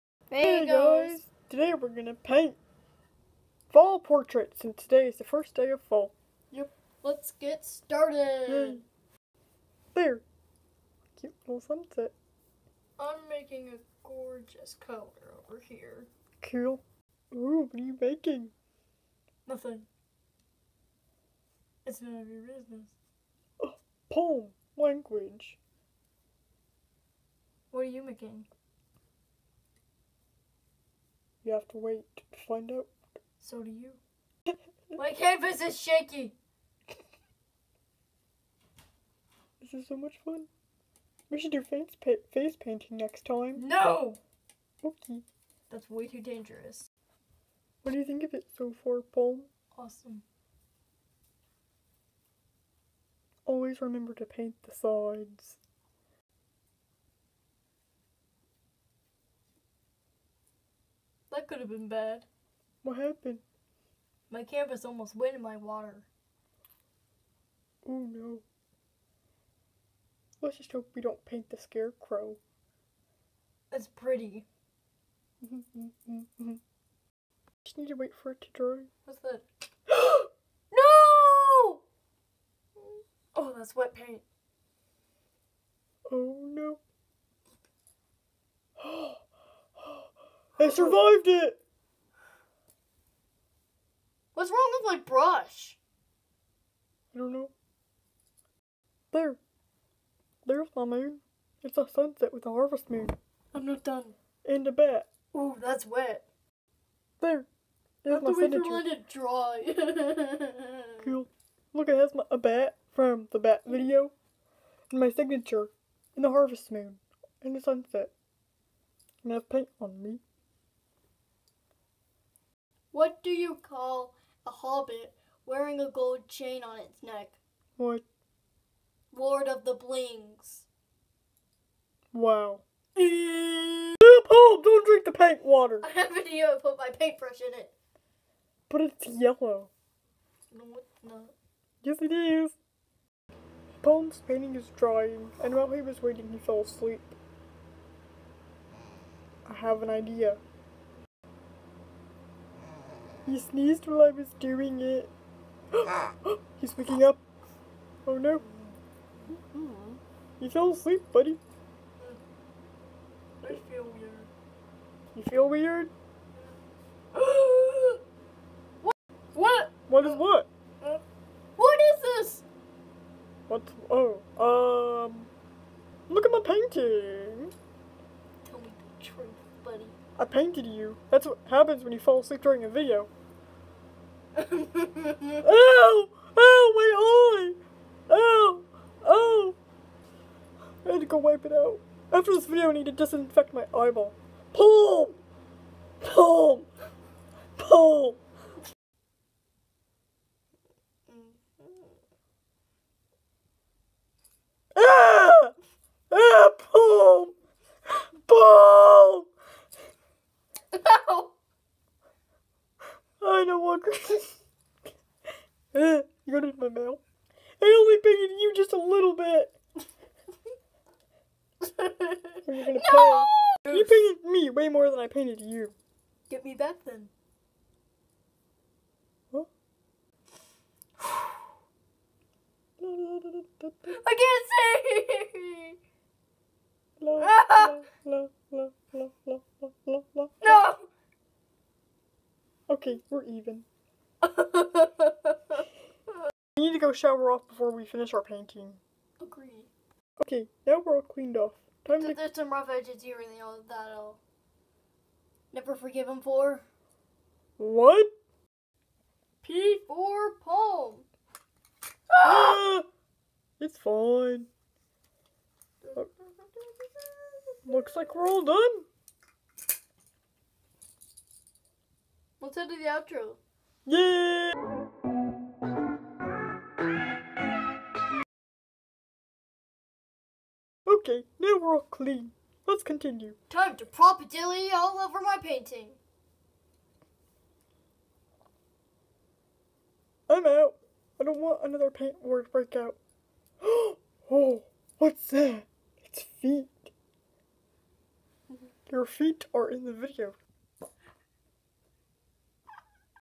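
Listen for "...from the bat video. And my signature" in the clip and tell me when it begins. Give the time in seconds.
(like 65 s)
112 s.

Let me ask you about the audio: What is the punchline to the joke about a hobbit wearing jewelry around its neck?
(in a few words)
Lord of the Blings.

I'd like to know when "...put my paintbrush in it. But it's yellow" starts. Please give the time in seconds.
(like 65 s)
136 s.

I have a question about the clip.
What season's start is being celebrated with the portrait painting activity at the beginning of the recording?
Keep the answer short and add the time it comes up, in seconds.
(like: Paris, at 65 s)
First day of fall, at 5 s.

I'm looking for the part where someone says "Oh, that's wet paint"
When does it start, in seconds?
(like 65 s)
83 s.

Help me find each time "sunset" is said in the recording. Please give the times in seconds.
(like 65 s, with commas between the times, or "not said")
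11 s, 101 s, 117 s.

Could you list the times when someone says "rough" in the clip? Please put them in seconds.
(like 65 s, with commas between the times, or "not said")
252 s.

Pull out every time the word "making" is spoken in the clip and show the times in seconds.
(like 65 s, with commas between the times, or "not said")
13 s, 17 s, 28 s.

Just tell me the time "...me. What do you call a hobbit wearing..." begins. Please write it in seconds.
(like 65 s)
120 s.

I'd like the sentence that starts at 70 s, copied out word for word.
Let's just hope we don't paint the scarecrow.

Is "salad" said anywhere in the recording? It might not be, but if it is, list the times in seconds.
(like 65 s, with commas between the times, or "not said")
not said.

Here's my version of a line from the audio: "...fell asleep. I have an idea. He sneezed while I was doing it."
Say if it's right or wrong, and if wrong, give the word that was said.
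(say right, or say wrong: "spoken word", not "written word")
right.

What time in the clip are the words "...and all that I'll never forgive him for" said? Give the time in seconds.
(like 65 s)
253 s.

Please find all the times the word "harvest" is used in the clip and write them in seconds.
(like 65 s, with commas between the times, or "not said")
102 s, 116 s.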